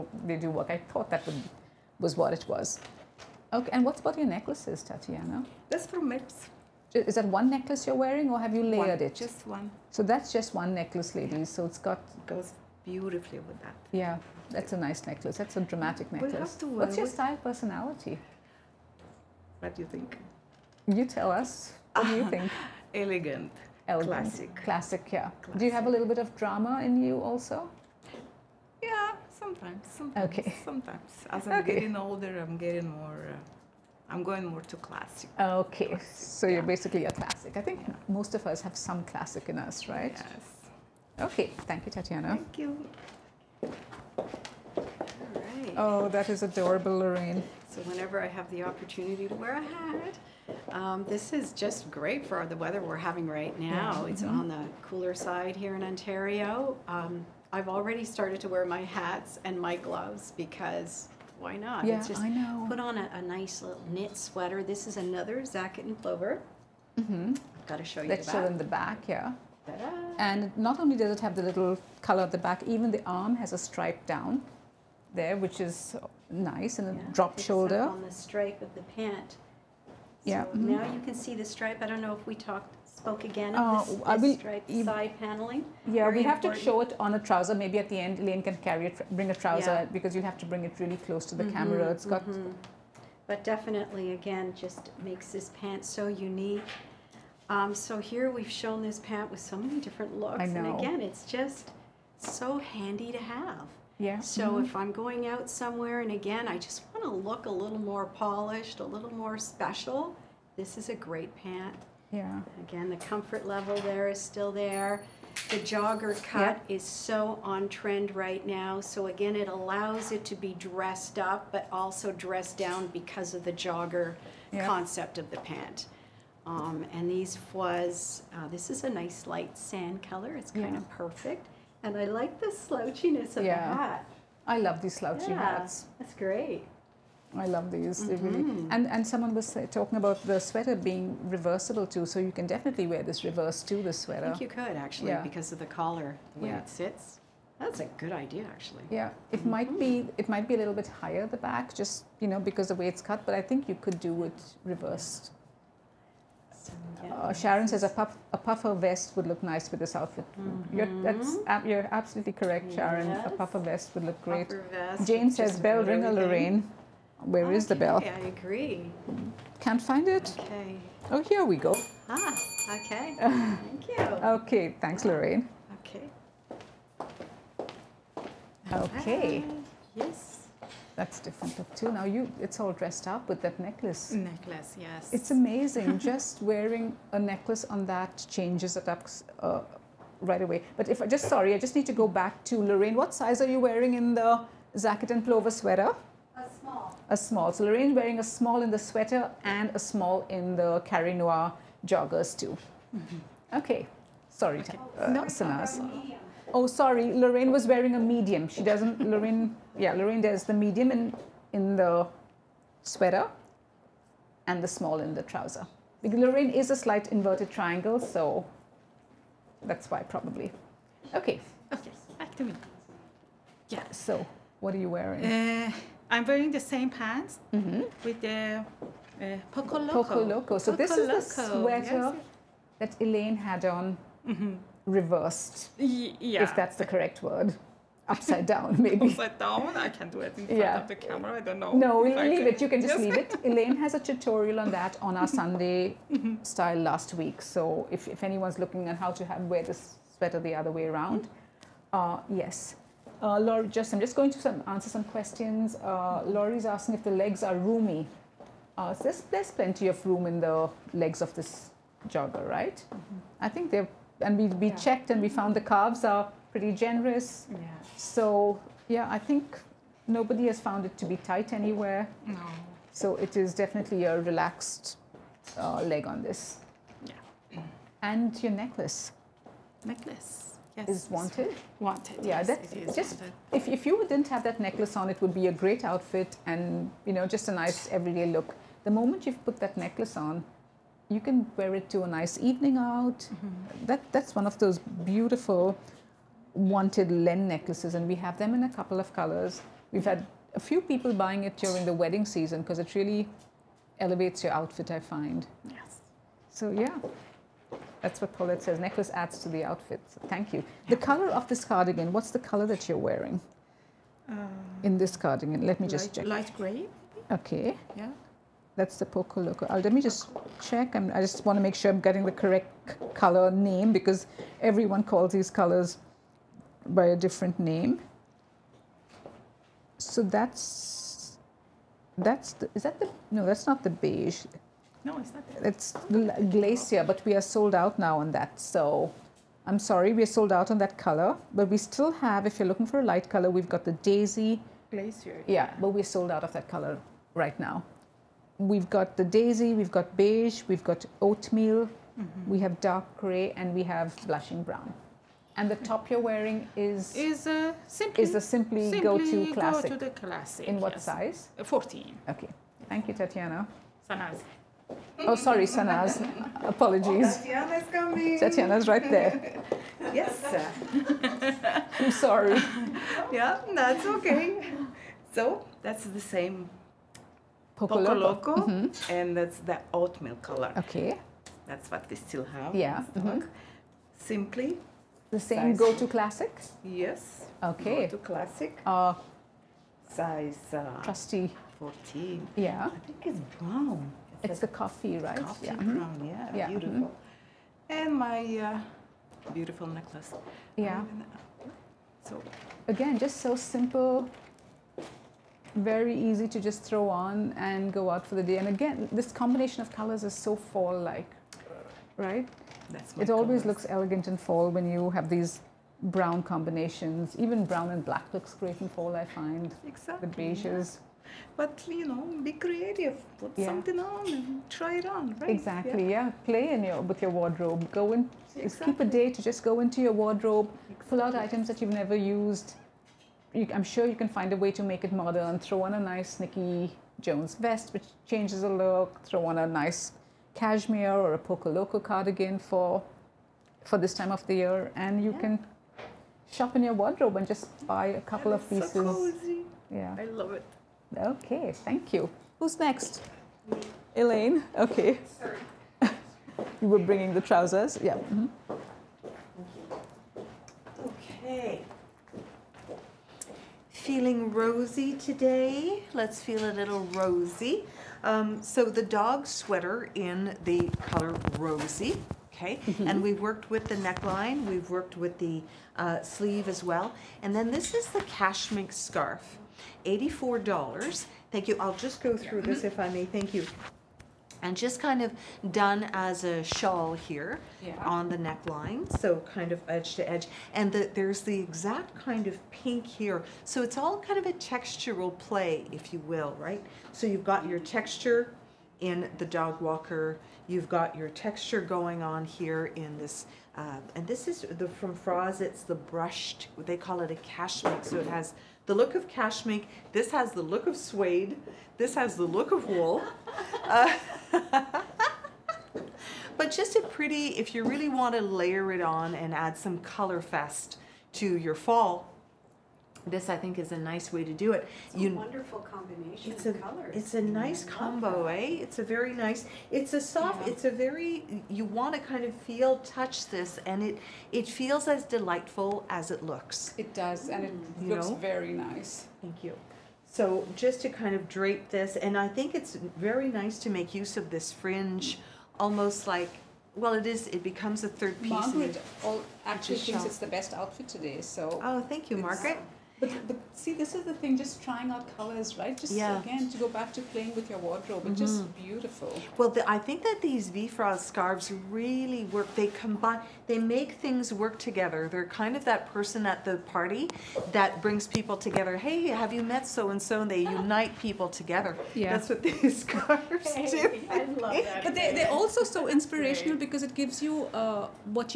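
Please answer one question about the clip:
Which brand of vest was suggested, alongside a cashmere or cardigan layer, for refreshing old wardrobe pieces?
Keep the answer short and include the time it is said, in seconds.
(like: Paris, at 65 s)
Nicky Jones, at 436 s.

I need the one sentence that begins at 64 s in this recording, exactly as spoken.
This is another Zaket and Plover.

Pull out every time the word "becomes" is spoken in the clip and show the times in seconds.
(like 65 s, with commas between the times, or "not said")
547 s.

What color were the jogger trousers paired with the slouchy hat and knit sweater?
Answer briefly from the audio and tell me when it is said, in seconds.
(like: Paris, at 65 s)
light sand, at 129 s.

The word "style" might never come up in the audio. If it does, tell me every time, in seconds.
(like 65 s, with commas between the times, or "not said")
17 s, 246 s.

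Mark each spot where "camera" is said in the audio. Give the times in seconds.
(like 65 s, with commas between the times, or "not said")
91 s, 240 s.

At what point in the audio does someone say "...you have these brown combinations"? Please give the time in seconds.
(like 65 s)
414 s.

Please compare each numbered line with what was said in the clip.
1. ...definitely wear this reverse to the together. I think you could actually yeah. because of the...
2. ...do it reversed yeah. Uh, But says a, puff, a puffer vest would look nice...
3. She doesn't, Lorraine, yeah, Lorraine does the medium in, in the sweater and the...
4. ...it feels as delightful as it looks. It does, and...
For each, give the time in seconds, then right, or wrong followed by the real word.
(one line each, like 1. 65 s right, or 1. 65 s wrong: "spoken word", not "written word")
1. 142 s wrong: "sweater", not "together"
2. 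154 s wrong: "Sharon", not "But"
3. 208 s right
4. 534 s right.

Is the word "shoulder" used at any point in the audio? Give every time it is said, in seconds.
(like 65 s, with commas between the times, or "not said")
77 s.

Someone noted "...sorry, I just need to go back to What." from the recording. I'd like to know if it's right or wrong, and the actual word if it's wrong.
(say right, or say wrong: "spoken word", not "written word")
wrong: "Lorraine", not "What".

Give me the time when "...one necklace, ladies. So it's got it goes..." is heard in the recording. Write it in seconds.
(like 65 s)
10 s.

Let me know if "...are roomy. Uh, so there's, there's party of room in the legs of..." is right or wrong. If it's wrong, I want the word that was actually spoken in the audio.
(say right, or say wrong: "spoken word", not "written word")
wrong: "plenty", not "party".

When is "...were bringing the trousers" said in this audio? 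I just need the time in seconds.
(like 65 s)
456 s.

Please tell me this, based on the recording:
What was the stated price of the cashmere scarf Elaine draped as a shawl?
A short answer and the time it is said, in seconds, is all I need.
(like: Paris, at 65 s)
$84, at 480 s.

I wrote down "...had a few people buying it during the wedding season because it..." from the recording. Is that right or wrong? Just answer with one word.
right.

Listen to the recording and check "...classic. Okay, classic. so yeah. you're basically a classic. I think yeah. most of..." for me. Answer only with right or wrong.
right.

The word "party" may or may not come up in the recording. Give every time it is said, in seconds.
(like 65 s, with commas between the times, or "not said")
566 s.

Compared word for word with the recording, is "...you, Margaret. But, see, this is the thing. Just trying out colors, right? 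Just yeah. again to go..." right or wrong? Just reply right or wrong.
right.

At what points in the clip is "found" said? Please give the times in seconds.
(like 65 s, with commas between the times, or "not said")
265 s, 270 s.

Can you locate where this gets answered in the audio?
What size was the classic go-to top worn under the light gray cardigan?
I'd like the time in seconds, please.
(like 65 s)
361 s.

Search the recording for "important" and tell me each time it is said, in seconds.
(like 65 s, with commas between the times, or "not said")
86 s.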